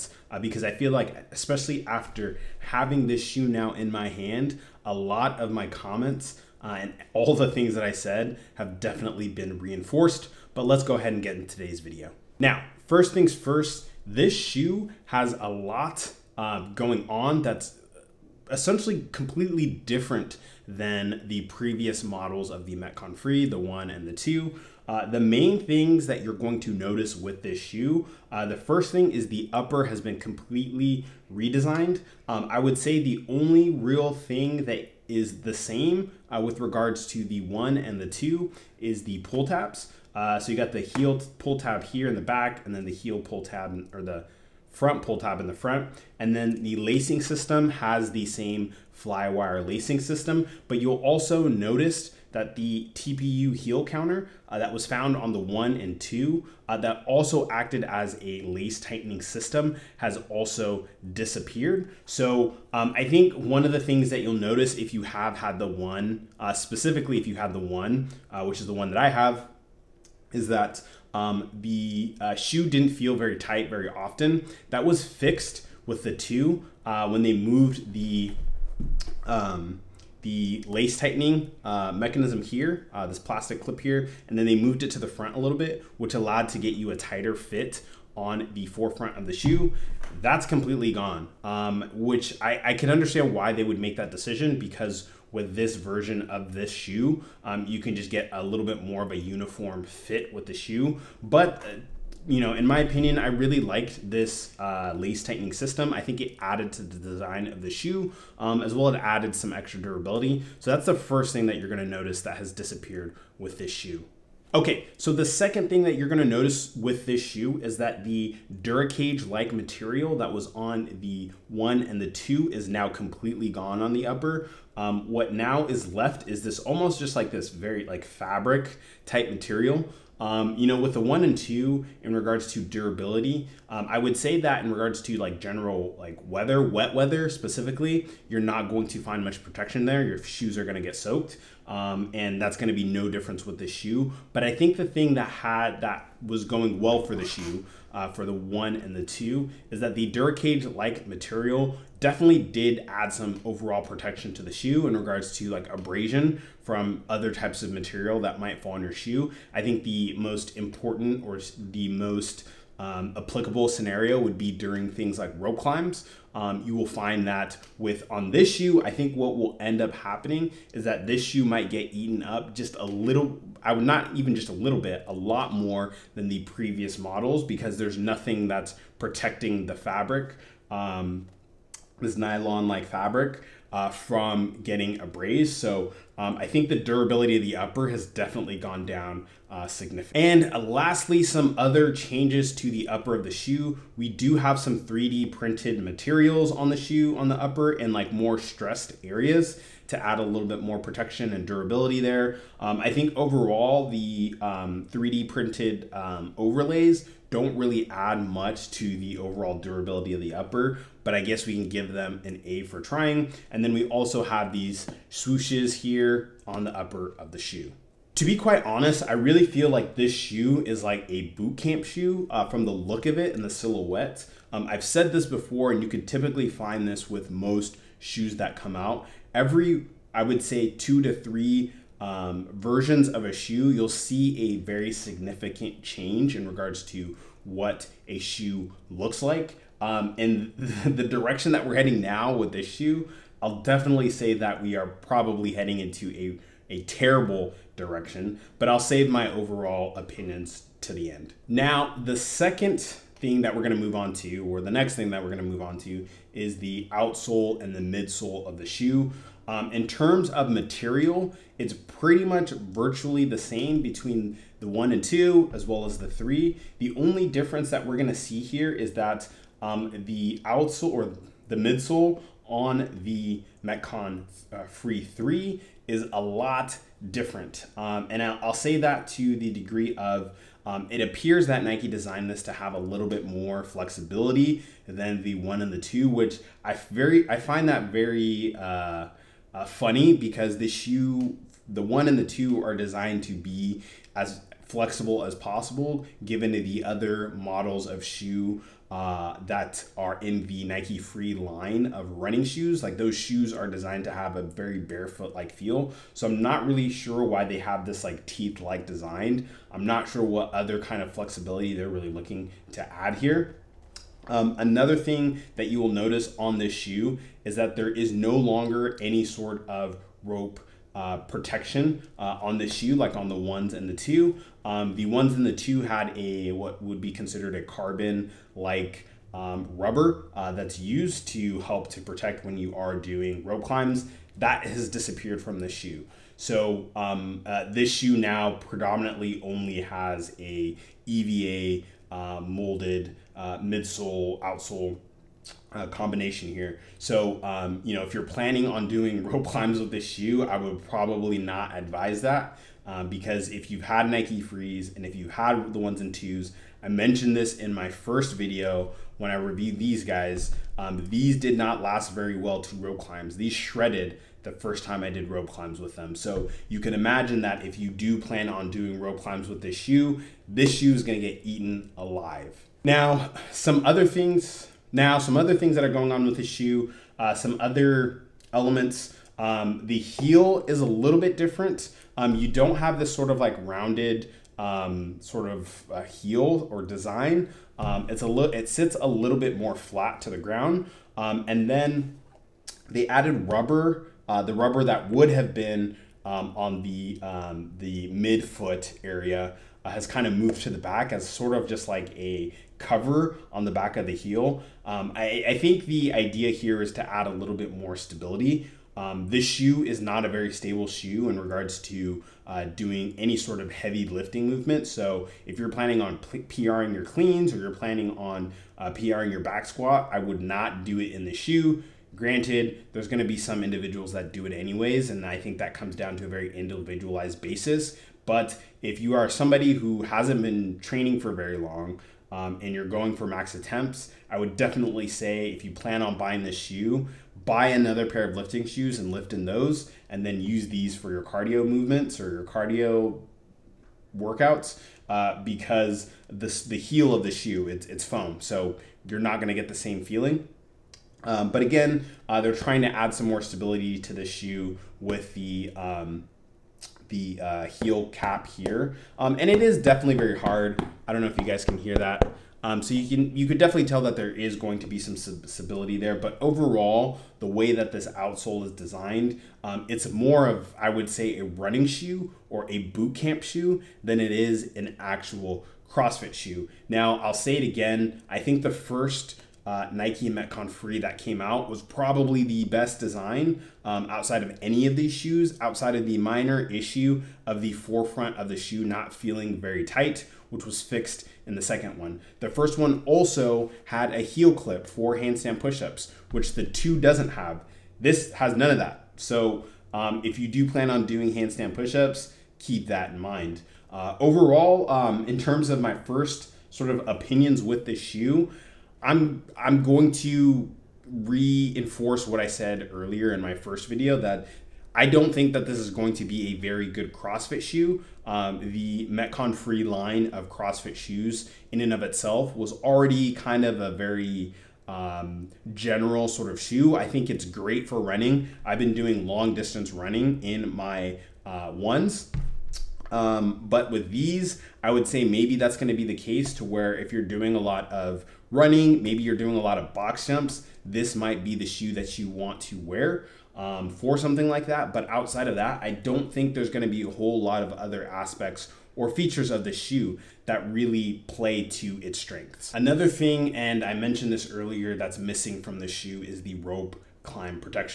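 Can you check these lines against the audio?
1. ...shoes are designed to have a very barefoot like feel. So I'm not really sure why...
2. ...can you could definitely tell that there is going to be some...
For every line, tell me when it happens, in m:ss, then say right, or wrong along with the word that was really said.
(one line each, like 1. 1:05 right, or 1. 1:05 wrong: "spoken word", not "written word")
1. 5:03 right
2. 7:43 right.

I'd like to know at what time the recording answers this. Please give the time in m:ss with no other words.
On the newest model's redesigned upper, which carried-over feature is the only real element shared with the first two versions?
0:39.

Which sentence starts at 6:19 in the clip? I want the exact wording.
Um, the heel is a little bit different.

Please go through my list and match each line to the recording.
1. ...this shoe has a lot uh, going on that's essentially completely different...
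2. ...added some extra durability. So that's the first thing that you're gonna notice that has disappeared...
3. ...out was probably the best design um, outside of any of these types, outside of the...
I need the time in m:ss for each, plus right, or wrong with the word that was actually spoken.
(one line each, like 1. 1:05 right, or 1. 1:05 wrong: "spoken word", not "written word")
1. 0:14 right
2. 1:48 right
3. 8:01 wrong: "shoes", not "types".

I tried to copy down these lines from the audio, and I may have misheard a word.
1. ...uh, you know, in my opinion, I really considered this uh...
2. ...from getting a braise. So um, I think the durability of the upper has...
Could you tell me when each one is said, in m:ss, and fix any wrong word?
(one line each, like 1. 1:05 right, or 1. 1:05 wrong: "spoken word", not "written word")
1. 1:41 wrong: "liked", not "considered"
2. 3:03 right.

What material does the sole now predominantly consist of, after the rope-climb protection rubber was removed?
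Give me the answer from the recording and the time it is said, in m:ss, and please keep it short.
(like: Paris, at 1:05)
EVA, at 5:41.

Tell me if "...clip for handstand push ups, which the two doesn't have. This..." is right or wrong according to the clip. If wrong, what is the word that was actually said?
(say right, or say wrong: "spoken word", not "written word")
right.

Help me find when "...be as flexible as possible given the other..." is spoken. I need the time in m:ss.
4:53.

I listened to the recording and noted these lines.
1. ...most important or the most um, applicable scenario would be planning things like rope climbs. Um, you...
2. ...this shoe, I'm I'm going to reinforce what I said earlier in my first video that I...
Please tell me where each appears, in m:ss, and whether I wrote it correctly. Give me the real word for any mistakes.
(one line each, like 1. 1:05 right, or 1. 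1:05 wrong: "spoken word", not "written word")
1. 2:40 wrong: "during", not "planning"
2. 8:27 right.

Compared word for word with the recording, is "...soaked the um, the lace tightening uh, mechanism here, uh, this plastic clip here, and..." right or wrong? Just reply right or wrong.
wrong.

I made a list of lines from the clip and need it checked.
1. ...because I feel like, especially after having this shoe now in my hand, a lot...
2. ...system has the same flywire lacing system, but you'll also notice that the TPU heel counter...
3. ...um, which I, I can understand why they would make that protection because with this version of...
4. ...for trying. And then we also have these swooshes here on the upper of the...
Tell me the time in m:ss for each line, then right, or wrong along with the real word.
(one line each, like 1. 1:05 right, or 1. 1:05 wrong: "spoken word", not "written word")
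1. 0:00 right
2. 0:47 right
3. 1:31 wrong: "decision", not "protection"
4. 3:32 right.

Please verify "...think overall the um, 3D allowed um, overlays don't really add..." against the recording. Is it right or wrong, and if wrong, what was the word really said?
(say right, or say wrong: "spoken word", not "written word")
wrong: "printed", not "allowed".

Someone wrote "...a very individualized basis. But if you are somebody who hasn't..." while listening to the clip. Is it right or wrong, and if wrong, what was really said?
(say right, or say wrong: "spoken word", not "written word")
right.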